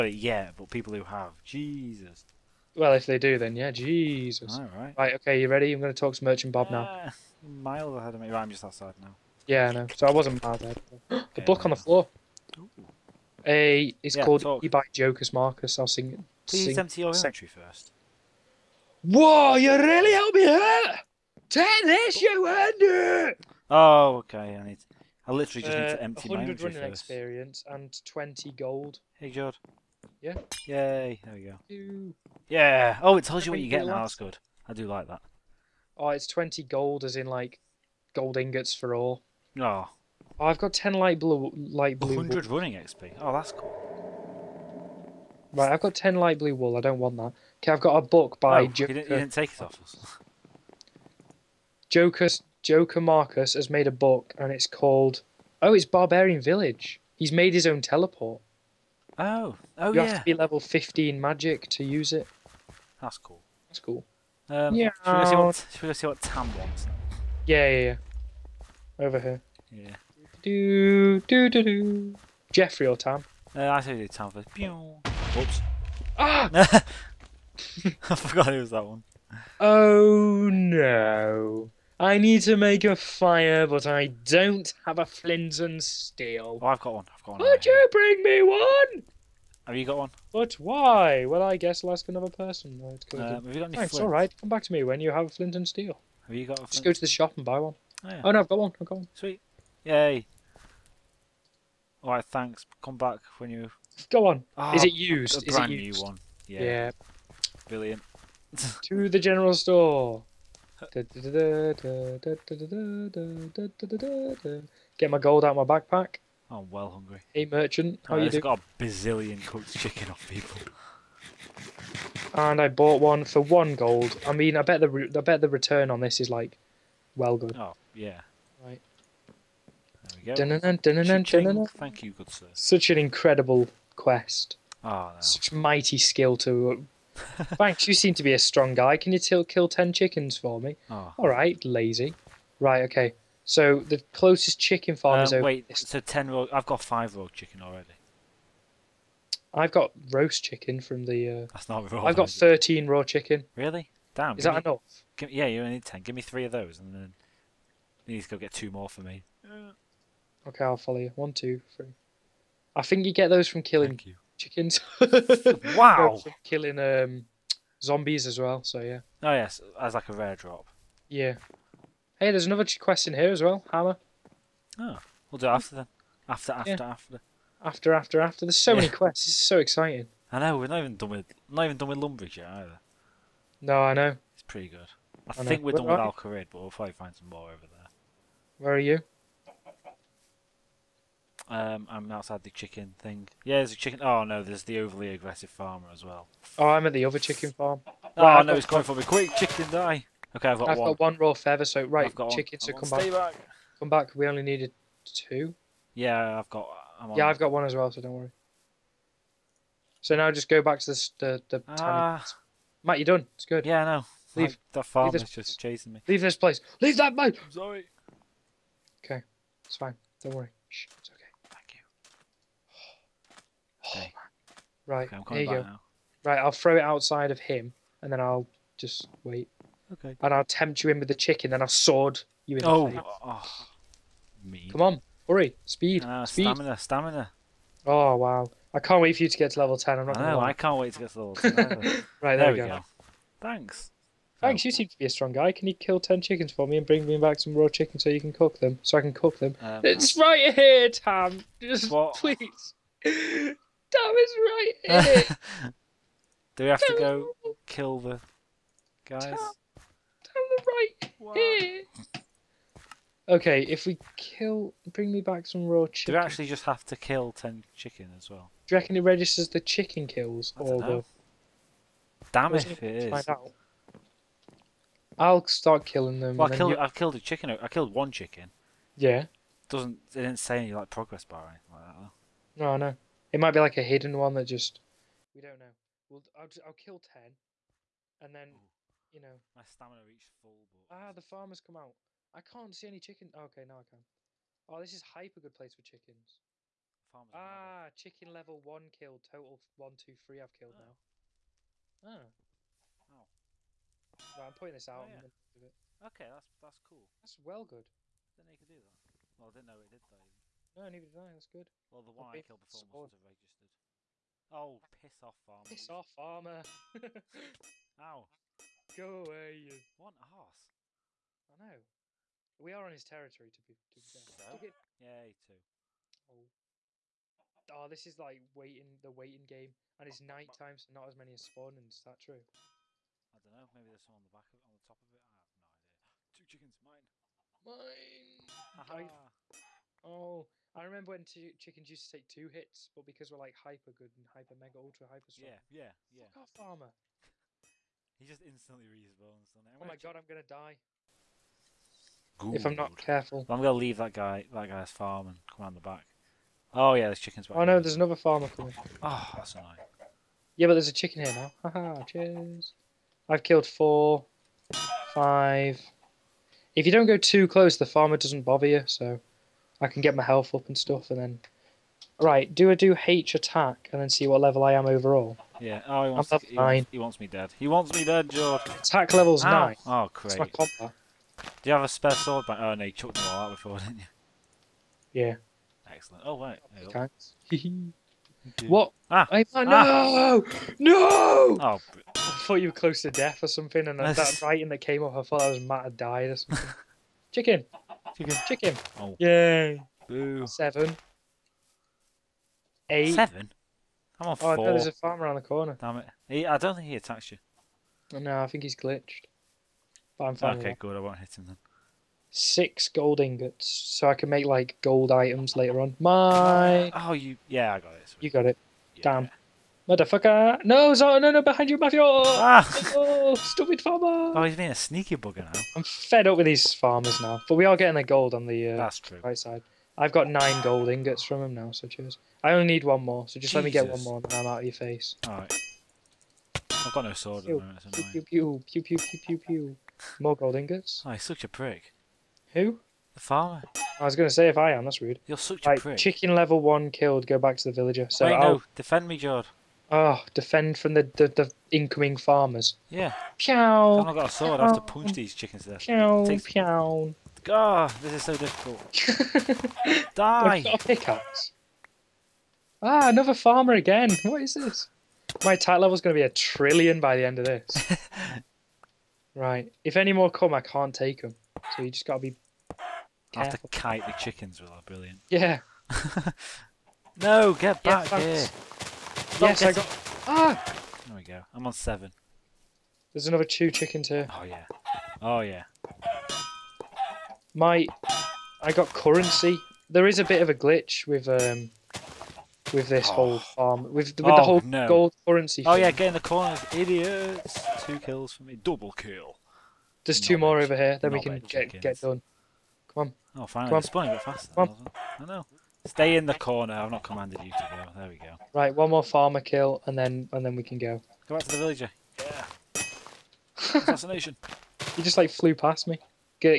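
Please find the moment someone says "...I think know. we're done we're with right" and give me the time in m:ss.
3:05.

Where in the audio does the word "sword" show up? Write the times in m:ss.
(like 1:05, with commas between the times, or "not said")
3:51, 6:22, 7:17, 7:34.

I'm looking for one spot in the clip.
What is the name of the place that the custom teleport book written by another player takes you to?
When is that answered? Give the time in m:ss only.
0:55.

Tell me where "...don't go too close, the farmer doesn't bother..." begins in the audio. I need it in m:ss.
6:06.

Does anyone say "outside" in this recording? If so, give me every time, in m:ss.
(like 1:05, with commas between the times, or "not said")
0:08, 3:12, 3:46.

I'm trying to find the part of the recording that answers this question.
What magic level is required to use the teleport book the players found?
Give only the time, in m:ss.
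1:00.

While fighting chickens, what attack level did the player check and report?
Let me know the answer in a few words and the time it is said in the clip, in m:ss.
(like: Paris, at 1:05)
9, at 6:19.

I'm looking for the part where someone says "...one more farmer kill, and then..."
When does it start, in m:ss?
8:28.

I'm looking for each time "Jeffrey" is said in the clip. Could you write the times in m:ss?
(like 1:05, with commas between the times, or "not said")
1:12.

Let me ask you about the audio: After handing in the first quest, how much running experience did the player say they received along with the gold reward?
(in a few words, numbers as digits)
100.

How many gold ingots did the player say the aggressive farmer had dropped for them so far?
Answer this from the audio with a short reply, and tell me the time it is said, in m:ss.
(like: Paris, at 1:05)
nine, at 7:10.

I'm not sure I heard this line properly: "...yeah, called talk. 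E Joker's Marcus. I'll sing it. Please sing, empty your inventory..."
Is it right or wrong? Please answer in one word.
right.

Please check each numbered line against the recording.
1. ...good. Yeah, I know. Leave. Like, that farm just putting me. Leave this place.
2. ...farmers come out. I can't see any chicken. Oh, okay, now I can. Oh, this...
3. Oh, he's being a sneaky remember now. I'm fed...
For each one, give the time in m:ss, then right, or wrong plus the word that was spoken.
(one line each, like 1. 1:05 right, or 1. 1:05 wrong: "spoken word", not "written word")
1. 3:33 wrong: "chasing", not "putting"
2. 4:51 right
3. 7:04 wrong: "bugger", not "remember".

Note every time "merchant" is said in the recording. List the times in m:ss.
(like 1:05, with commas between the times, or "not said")
0:06, 1:57.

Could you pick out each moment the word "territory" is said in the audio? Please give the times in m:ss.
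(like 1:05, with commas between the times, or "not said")
5:23.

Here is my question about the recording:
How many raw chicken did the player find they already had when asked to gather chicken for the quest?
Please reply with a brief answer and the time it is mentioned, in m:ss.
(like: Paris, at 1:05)
13, at 2:32.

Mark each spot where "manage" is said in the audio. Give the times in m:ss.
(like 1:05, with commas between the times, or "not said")
not said.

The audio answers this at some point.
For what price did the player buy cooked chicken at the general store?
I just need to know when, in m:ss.
2:03.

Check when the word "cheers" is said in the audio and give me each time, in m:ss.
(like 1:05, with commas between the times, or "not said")
6:02, 7:11.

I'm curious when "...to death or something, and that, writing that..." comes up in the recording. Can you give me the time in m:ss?
6:33.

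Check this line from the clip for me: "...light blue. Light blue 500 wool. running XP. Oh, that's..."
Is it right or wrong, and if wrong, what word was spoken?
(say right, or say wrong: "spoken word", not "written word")
wrong: "100", not "500".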